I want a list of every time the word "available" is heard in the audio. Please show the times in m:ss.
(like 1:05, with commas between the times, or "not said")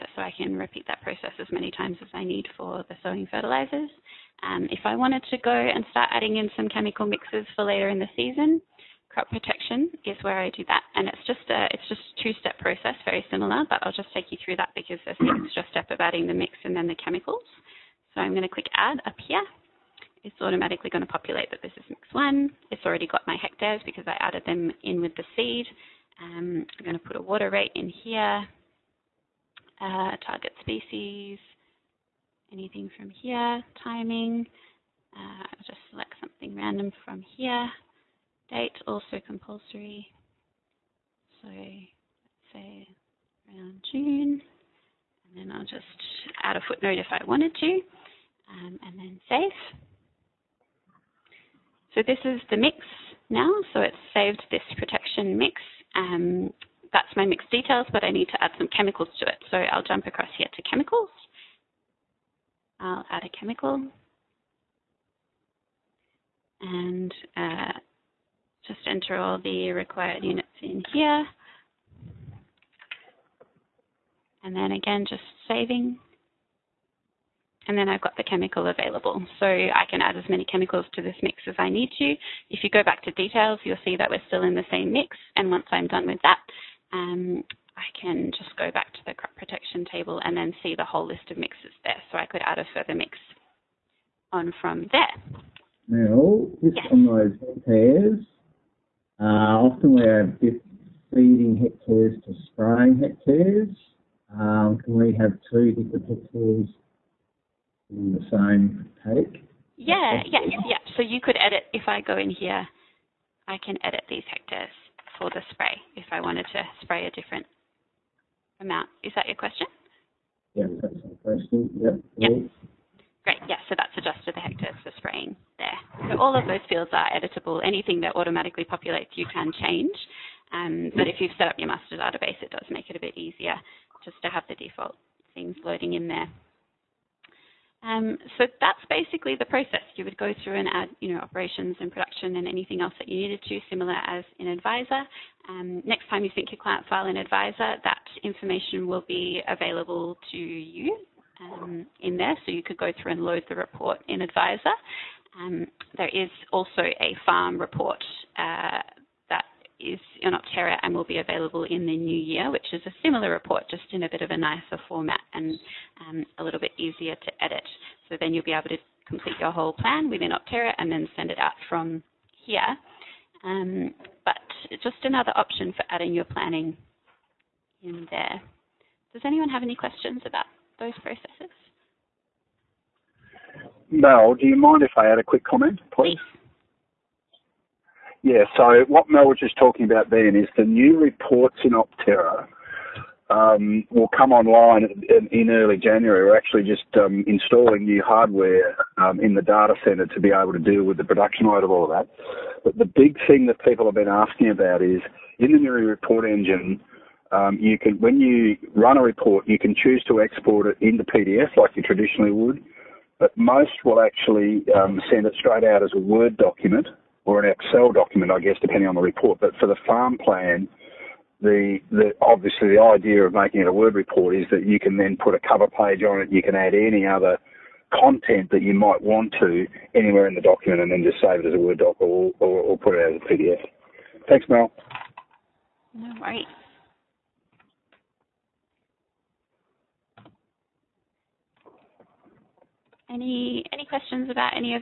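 1:18, 2:29, 2:41.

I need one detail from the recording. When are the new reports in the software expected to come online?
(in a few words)
Early January.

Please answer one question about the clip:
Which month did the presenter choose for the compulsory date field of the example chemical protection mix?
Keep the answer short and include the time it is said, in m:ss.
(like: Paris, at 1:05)
June, at 0:43.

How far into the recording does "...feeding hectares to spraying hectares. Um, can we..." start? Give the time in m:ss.
1:41.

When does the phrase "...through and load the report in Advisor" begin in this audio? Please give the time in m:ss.
2:33.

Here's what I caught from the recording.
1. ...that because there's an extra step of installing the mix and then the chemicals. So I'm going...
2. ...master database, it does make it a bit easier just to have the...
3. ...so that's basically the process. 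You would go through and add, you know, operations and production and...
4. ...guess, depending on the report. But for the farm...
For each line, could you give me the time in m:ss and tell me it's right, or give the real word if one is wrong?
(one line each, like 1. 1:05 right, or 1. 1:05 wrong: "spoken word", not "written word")
1. 0:14 wrong: "adding", not "installing"
2. 2:11 right
3. 2:18 right
4. 3:38 right.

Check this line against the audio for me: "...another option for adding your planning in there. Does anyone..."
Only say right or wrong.
right.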